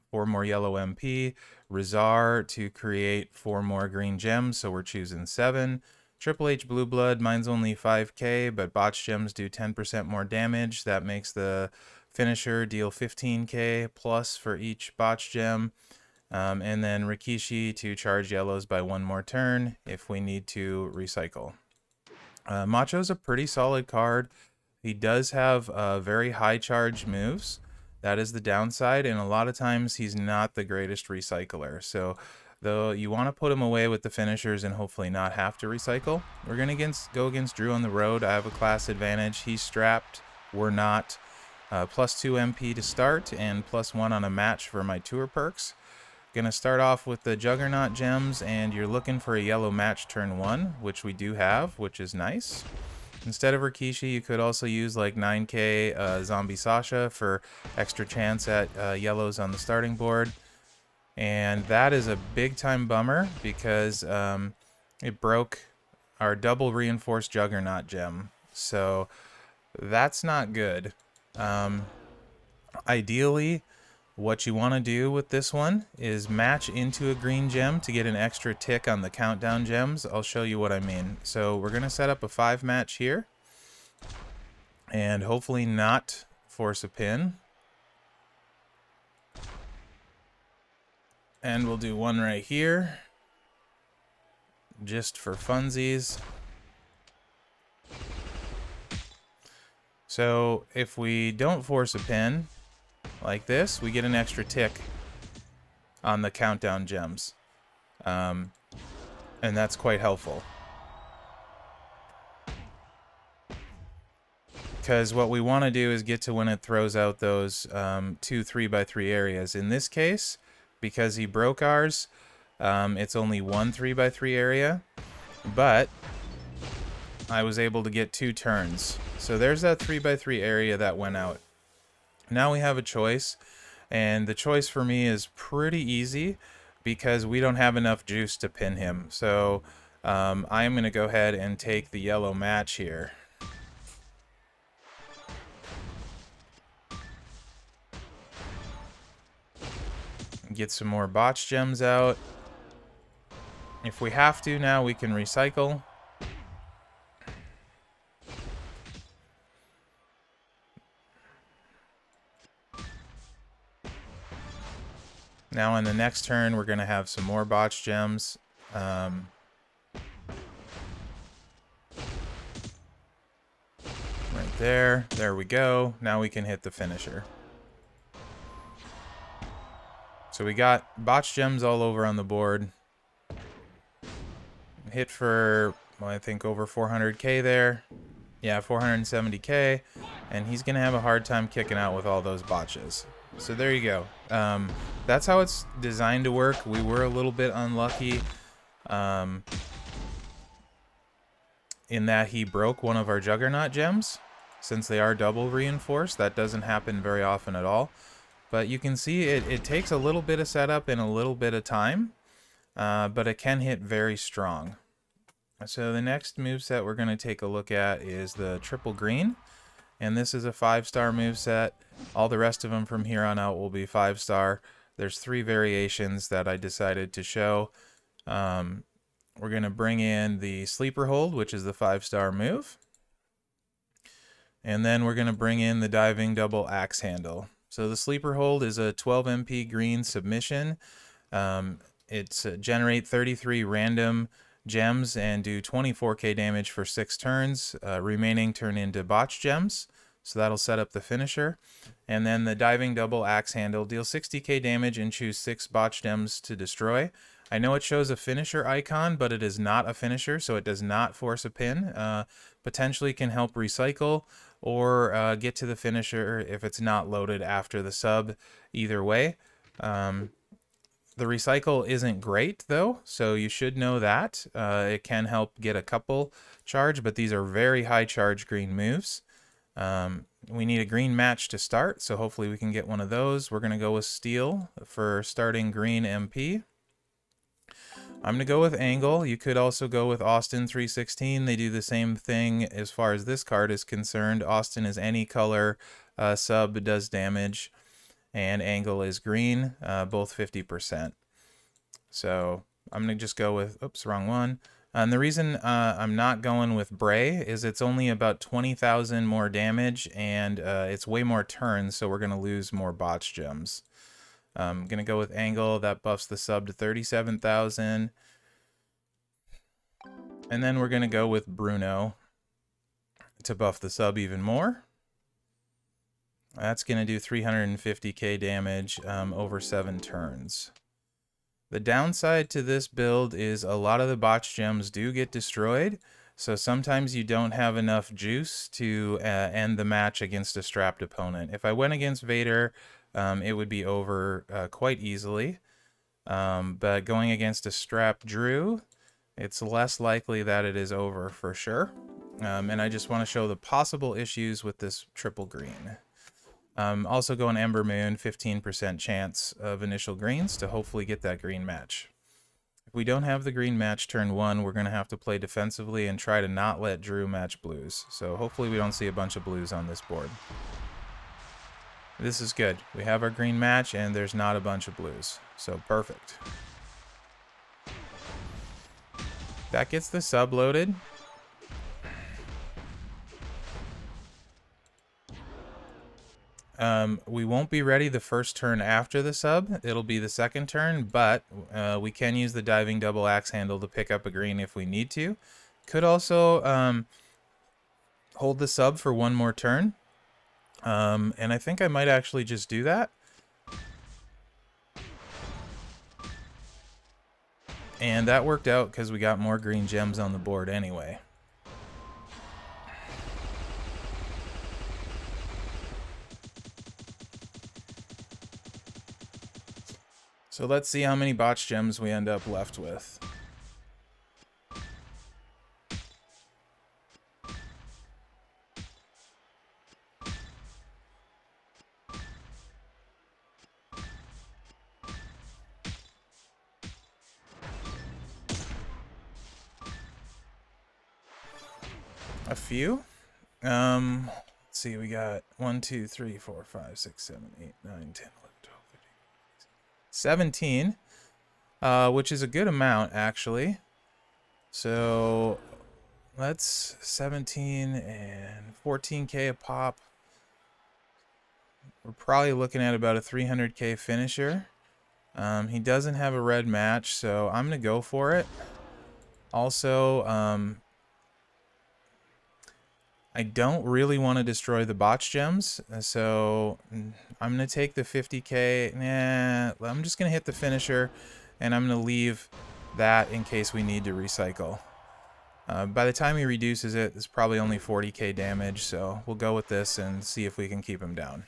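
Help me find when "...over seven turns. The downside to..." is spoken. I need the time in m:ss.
5:29.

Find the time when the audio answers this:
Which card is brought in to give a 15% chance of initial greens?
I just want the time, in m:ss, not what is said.
5:57.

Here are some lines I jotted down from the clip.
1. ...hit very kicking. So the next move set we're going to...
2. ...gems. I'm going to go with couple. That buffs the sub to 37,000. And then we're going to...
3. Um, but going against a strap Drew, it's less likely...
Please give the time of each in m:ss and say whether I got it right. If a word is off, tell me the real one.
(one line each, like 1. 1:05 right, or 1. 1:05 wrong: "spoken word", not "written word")
1. 3:33 wrong: "strong", not "kicking"
2. 5:13 wrong: "angle", not "couple"
3. 5:46 right.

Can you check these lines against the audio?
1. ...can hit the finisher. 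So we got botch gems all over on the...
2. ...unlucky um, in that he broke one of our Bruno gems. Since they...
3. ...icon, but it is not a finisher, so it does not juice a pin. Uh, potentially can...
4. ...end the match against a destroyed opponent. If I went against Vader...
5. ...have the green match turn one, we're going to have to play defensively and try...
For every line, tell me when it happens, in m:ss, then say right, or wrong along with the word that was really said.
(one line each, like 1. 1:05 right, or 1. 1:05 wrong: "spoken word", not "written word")
1. 2:56 right
2. 3:17 wrong: "Juggernaut", not "Bruno"
3. 4:18 wrong: "force", not "juice"
4. 5:39 wrong: "strapped", not "destroyed"
5. 6:03 right.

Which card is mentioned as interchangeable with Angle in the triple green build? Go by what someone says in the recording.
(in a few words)
Austin 316.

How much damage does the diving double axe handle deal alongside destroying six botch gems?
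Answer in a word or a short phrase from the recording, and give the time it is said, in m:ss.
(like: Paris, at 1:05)
60k, at 4:14.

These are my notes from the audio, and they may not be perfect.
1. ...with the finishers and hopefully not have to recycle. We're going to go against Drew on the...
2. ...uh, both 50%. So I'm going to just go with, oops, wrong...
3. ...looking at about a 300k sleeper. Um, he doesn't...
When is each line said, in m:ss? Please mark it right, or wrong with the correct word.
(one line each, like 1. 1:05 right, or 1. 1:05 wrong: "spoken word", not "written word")
1. 0:33 right
2. 4:59 right
3. 7:42 wrong: "finisher", not "sleeper".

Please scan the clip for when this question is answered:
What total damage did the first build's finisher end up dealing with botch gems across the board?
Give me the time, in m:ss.
3:08.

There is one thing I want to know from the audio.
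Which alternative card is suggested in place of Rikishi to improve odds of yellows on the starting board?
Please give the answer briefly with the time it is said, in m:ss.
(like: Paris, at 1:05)
Zombie Sasha, at 0:56.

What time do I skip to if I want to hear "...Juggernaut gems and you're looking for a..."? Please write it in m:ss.
0:47.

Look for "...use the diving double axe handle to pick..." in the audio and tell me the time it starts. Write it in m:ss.
6:32.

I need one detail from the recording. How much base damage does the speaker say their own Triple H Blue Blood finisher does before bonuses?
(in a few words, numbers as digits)
5k.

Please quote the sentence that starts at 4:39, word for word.
Um, we need a green match to start, so hopefully we can get one of those.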